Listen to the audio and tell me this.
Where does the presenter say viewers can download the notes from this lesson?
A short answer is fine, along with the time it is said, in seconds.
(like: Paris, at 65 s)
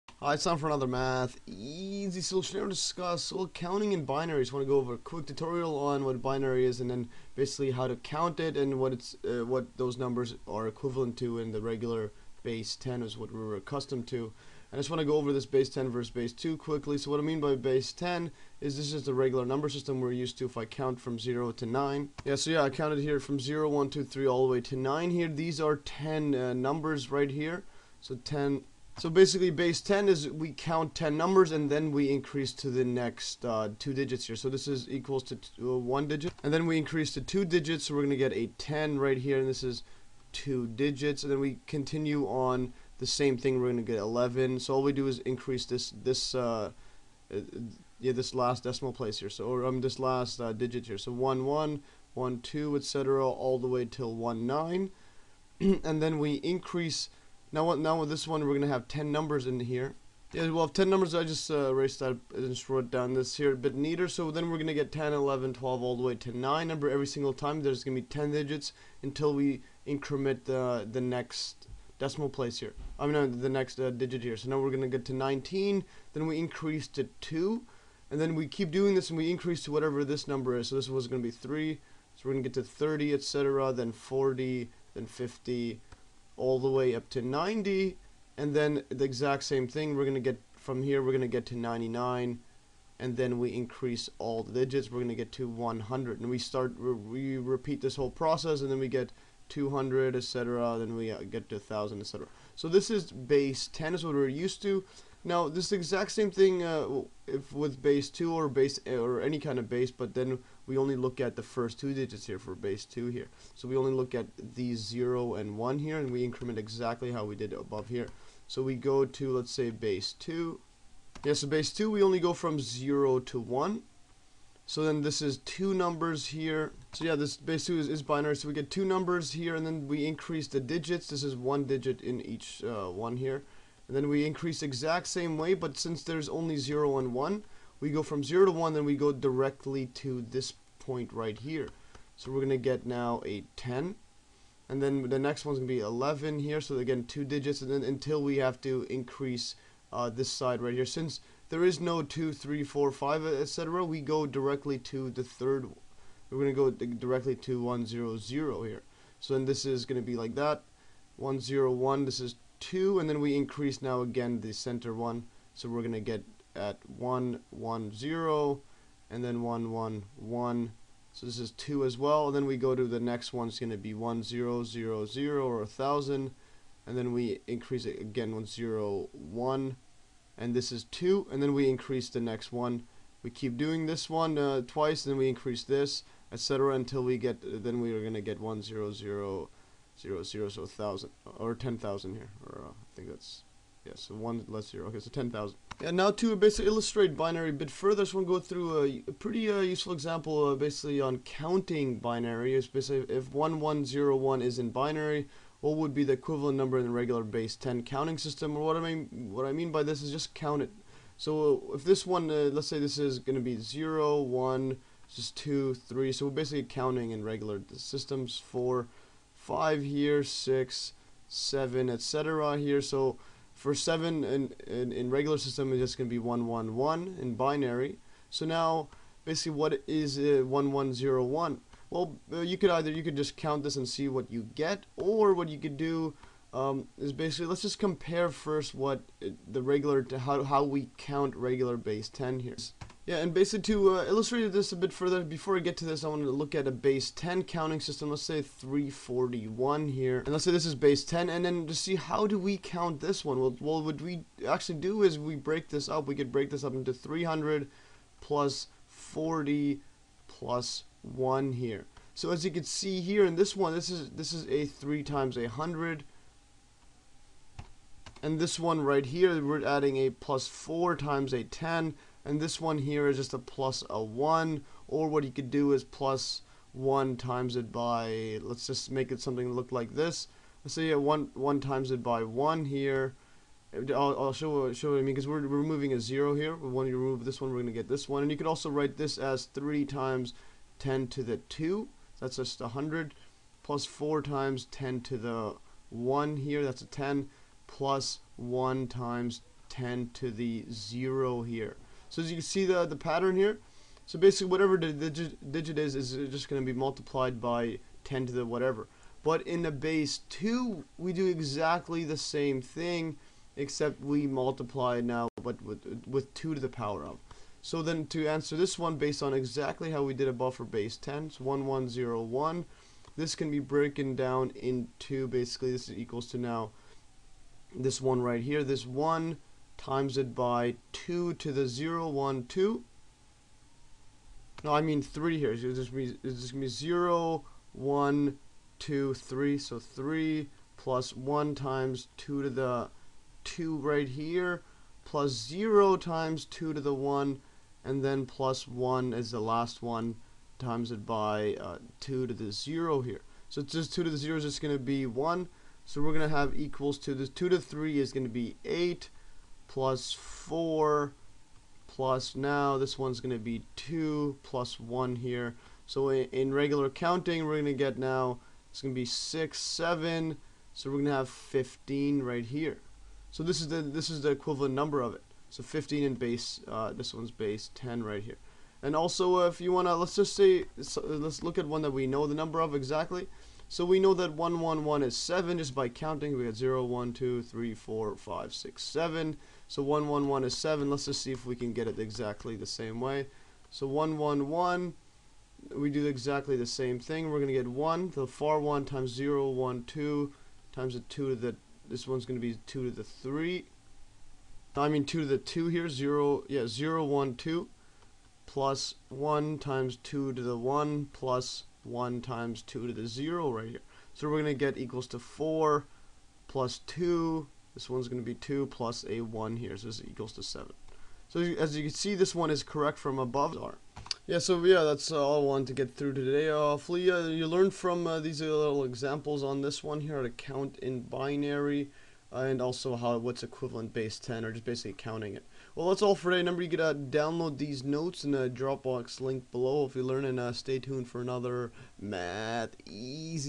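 Dropbox link, at 438 s.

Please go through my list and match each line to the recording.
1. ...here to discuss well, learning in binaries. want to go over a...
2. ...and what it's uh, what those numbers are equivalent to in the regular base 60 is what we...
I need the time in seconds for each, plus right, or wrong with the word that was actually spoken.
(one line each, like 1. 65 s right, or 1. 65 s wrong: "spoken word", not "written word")
1. 2 s wrong: "counting", not "learning"
2. 8 s wrong: "10", not "60".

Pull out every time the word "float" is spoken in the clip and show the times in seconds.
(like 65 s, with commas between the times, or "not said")
not said.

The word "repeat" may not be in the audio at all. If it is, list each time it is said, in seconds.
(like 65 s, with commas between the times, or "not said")
97 s.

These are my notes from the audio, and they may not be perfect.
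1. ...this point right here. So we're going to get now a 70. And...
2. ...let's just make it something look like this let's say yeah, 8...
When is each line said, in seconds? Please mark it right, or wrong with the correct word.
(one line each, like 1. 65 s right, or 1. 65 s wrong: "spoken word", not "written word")
1. 140 s wrong: "10", not "70"
2. 278 s wrong: "1", not "8".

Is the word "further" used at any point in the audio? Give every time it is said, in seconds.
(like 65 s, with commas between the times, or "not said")
197 s, 244 s.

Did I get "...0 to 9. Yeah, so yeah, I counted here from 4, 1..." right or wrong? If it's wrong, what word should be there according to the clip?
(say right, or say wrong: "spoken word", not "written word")
wrong: "0", not "4".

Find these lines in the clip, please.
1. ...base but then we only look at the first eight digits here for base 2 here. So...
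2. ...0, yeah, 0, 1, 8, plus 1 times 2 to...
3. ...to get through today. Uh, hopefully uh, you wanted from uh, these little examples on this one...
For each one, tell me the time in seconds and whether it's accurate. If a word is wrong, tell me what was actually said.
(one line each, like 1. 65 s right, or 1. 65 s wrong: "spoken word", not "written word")
1. 109 s wrong: "two", not "eight"
2. 405 s wrong: "2", not "8"
3. 425 s wrong: "learned", not "wanted".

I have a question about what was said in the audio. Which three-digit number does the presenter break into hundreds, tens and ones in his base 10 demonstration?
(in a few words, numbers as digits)
341.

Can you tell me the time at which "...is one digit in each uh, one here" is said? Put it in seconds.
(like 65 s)
131 s.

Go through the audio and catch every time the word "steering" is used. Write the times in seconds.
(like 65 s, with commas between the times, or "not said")
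not said.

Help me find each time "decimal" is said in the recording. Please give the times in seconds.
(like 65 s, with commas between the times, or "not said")
48 s, 71 s.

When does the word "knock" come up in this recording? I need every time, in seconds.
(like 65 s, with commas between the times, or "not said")
not said.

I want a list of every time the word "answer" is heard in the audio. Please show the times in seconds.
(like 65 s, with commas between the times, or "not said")
318 s.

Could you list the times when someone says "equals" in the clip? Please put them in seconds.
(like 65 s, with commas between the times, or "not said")
34 s, 325 s, 356 s, 414 s, 420 s.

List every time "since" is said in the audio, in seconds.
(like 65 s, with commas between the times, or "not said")
135 s, 150 s.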